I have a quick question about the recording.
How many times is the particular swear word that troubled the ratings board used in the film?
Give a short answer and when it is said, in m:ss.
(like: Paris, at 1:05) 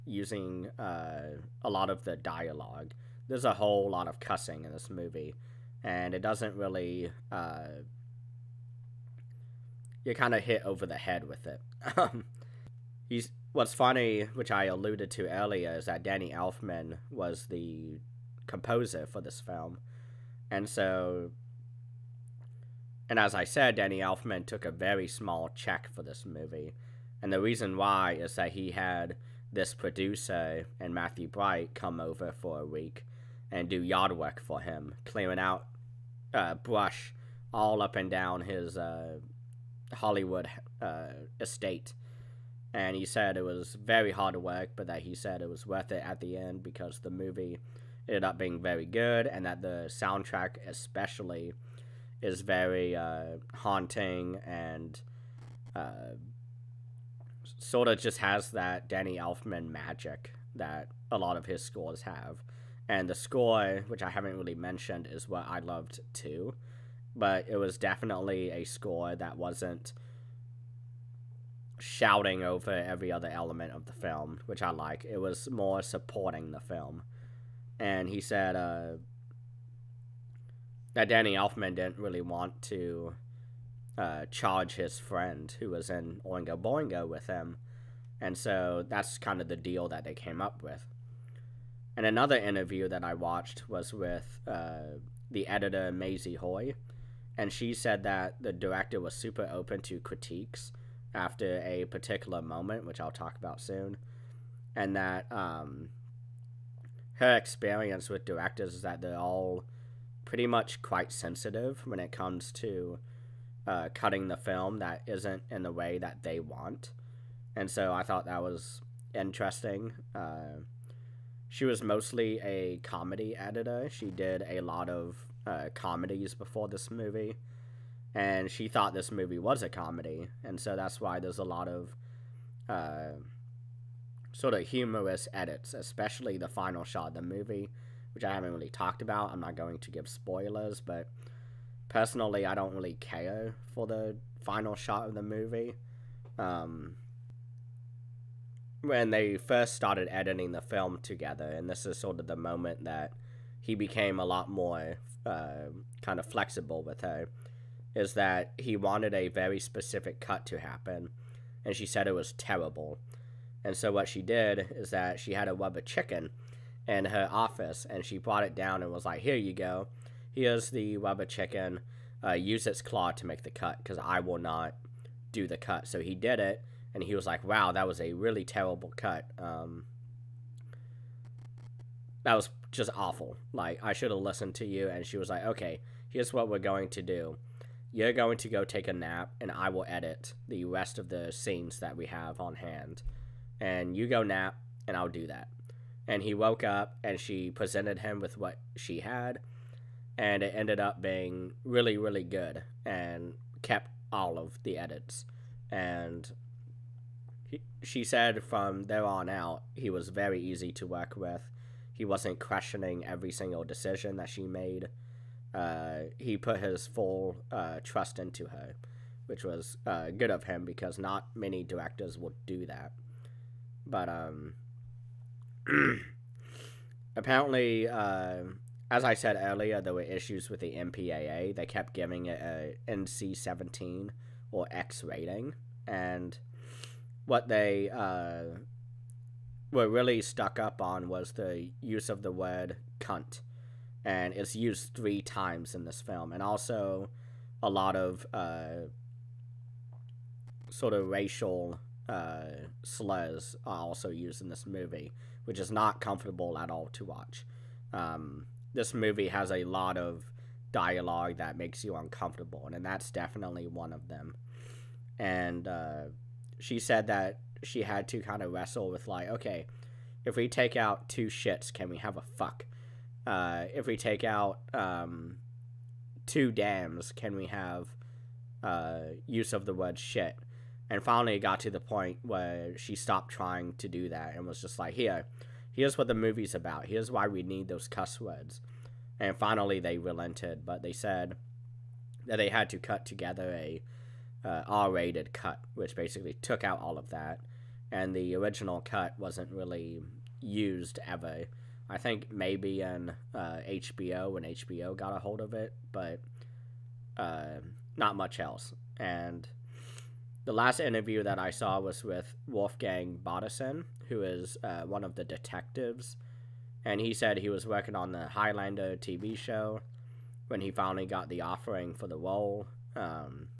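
3, at 4:04.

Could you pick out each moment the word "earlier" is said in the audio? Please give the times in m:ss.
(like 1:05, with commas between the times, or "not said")
0:15, 3:49.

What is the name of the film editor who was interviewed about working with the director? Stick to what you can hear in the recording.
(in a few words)
Maisie Hoy.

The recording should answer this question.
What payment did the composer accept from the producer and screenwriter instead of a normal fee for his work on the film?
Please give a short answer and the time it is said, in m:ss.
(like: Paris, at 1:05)
Yard work, at 0:33.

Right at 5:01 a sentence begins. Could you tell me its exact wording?
I think maybe in uh, HBO when HBO got a hold of it, but uh, not much else.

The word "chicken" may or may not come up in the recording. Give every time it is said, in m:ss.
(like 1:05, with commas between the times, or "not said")
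2:45, 2:51.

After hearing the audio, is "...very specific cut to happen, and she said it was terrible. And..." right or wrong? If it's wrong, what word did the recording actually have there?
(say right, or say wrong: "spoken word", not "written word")
right.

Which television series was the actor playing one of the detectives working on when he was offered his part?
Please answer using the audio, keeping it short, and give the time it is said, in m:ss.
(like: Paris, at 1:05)
Highlander, at 5:18.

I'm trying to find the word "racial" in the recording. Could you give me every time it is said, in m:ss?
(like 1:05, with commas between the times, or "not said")
4:11.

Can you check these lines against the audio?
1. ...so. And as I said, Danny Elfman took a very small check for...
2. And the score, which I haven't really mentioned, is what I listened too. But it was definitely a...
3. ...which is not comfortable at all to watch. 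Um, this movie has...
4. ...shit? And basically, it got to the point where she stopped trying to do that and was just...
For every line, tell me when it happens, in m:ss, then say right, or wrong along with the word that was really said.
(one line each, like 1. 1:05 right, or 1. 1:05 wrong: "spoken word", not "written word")
1. 0:20 right
2. 1:02 wrong: "loved", not "listened"
3. 4:15 right
4. 4:39 wrong: "finally", not "basically".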